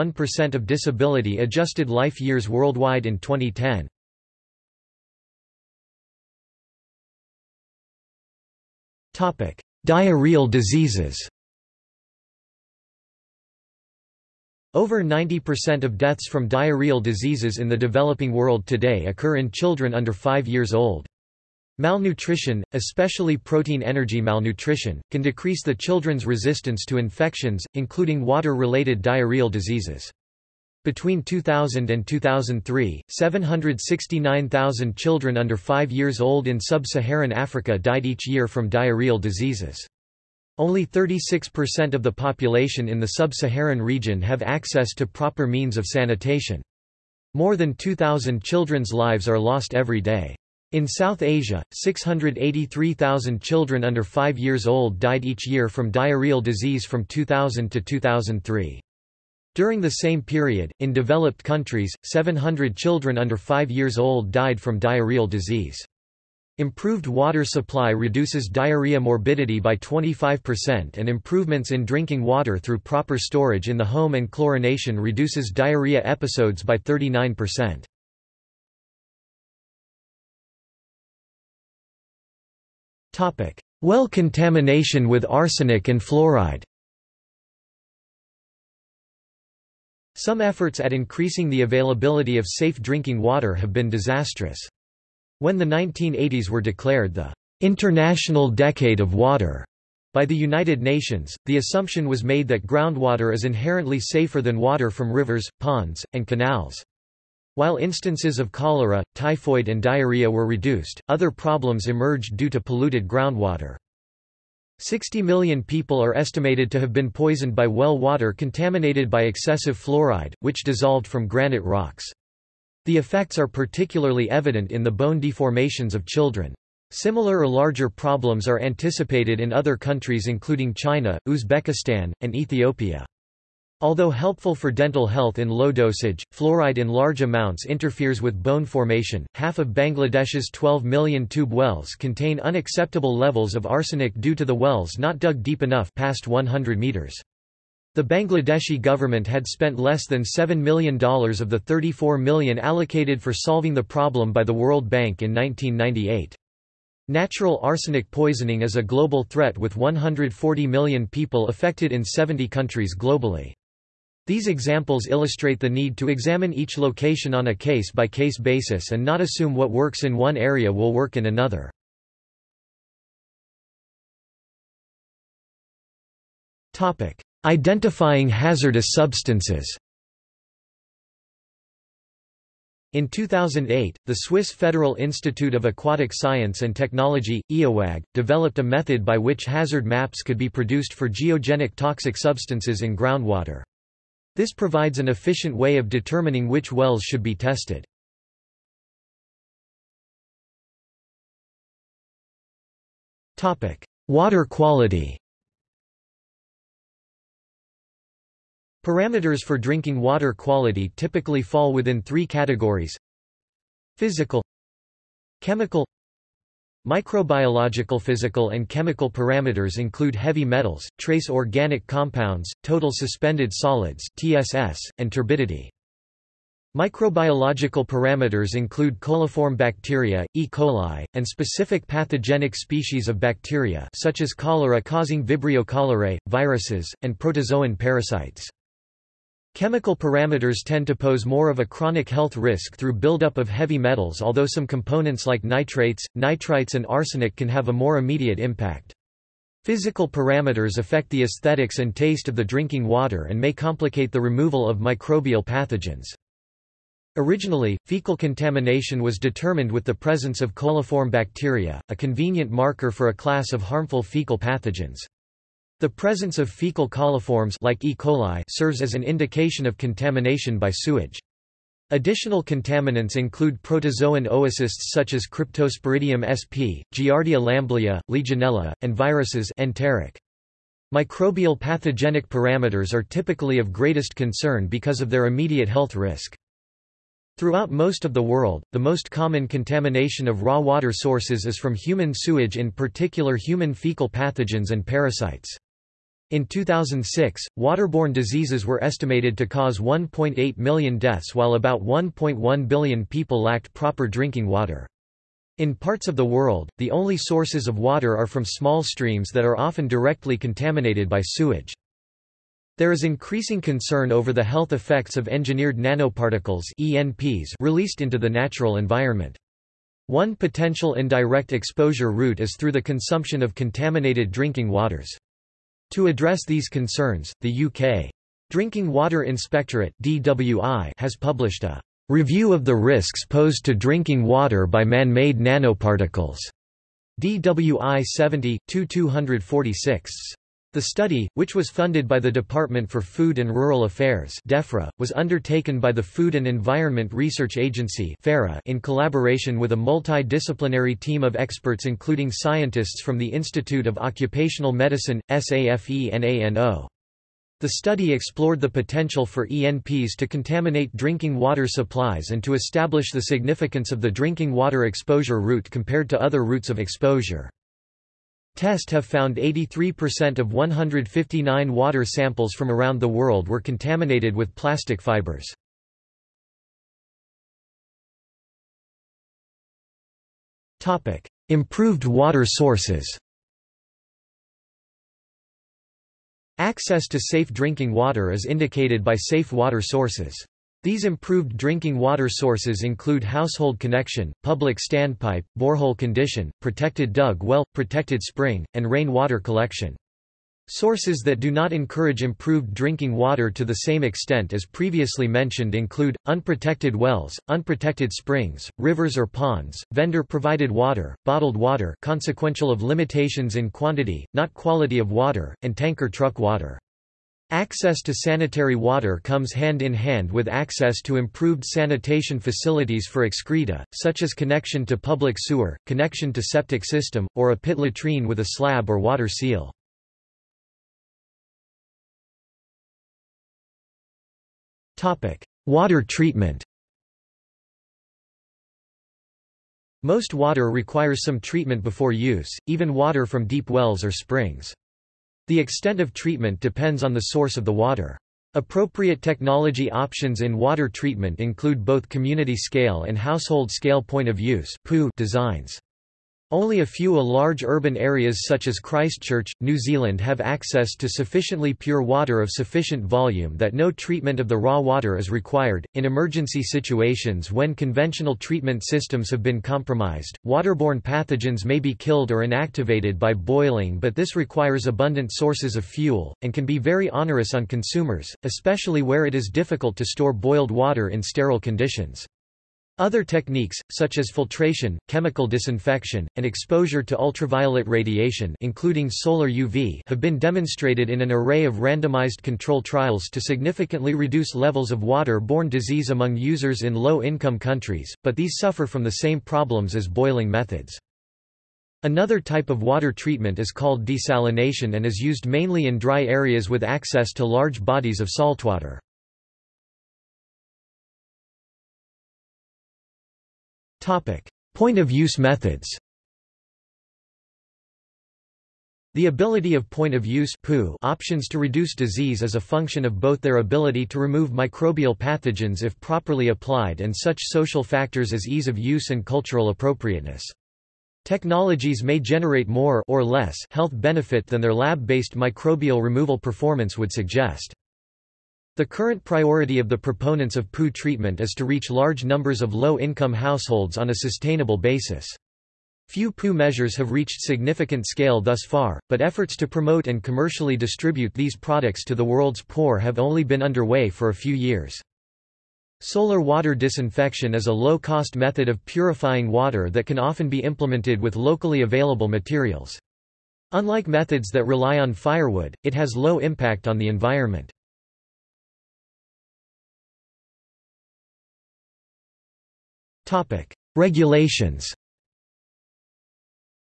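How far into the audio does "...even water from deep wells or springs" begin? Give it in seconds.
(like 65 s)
442 s.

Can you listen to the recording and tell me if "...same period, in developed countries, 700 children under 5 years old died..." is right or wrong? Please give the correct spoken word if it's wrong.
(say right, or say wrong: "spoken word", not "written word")
right.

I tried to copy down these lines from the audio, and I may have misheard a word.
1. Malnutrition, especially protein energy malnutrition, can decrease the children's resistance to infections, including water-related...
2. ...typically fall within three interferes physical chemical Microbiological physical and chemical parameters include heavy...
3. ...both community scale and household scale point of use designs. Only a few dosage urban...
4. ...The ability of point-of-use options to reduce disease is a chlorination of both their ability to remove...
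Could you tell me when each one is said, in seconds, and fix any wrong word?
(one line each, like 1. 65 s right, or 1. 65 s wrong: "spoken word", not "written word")
1. 21 s right
2. 210 s wrong: "categories", not "interferes"
3. 451 s wrong: "large", not "dosage"
4. 519 s wrong: "function", not "chlorination".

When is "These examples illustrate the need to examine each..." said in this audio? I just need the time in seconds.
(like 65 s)
164 s.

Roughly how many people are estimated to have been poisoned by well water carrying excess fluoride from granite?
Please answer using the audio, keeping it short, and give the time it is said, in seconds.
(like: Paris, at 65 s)
60 million, at 114 s.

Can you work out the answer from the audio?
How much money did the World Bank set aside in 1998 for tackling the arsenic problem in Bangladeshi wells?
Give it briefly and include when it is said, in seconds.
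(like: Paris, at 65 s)
$34 million, at 151 s.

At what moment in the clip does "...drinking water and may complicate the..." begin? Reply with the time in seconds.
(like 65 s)
252 s.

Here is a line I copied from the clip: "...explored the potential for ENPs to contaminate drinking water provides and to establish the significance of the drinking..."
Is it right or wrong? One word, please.
wrong.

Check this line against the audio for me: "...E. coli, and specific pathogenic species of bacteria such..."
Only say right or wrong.
right.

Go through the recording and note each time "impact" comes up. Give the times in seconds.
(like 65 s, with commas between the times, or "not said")
248 s, 566 s.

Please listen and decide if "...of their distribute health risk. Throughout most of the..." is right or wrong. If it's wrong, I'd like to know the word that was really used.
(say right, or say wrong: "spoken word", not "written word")
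wrong: "immediate", not "distribute".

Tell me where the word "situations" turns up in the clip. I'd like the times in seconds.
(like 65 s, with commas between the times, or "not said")
466 s.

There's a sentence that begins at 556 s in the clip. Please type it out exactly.
Solar water disinfection is a low-cost method of purifying water that can often be implemented with locally available materials.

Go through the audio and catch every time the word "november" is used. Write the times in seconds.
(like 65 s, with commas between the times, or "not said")
not said.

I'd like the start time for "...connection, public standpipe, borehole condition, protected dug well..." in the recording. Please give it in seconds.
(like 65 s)
393 s.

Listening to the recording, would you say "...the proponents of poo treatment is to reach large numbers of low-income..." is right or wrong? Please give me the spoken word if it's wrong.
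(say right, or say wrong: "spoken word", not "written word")
right.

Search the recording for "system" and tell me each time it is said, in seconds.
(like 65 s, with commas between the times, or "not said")
426 s, 468 s.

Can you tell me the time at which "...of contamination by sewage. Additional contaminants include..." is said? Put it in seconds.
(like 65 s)
269 s.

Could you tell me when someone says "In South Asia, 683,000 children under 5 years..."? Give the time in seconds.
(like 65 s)
50 s.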